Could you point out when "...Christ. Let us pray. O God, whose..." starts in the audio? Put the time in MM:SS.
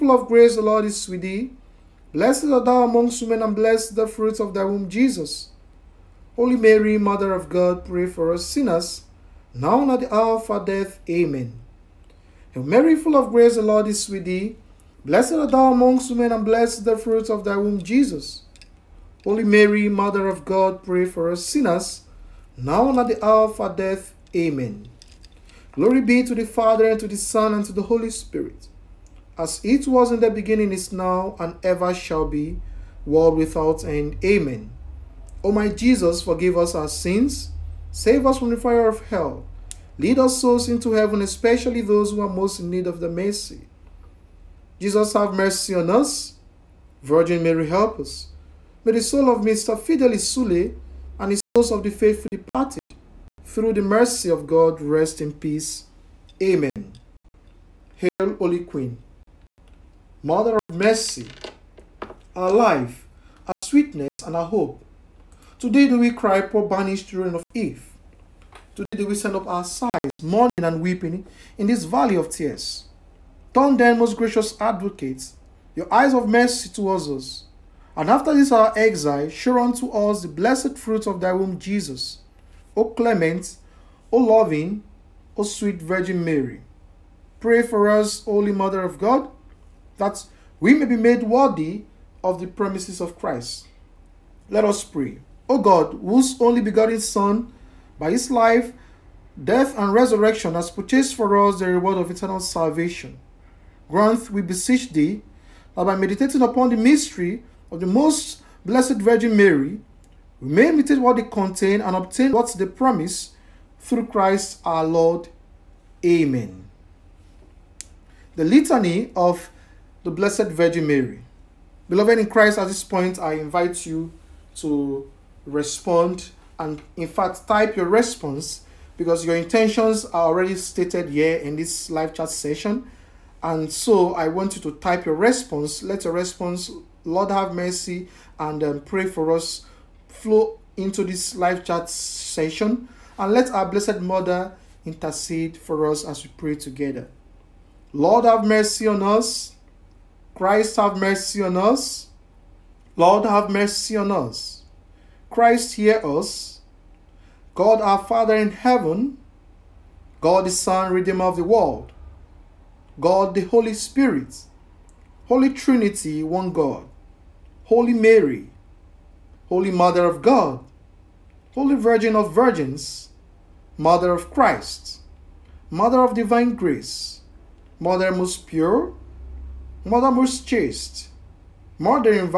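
01:33.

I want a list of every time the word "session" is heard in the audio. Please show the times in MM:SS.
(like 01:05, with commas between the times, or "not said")
02:12, 02:21.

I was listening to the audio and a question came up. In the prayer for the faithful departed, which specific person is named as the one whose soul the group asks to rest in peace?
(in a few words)
Mr. Fidelis Sule.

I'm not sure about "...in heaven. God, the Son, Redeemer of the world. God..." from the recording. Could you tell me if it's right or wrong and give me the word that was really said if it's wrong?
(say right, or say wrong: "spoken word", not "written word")
right.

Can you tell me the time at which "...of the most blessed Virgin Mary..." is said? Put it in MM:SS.
01:47.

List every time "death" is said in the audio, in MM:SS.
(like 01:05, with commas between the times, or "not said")
00:10, 00:23, 01:39.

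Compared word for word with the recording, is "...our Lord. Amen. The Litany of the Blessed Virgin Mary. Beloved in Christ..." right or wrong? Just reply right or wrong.
right.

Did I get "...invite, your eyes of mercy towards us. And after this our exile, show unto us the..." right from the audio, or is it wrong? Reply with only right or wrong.
wrong.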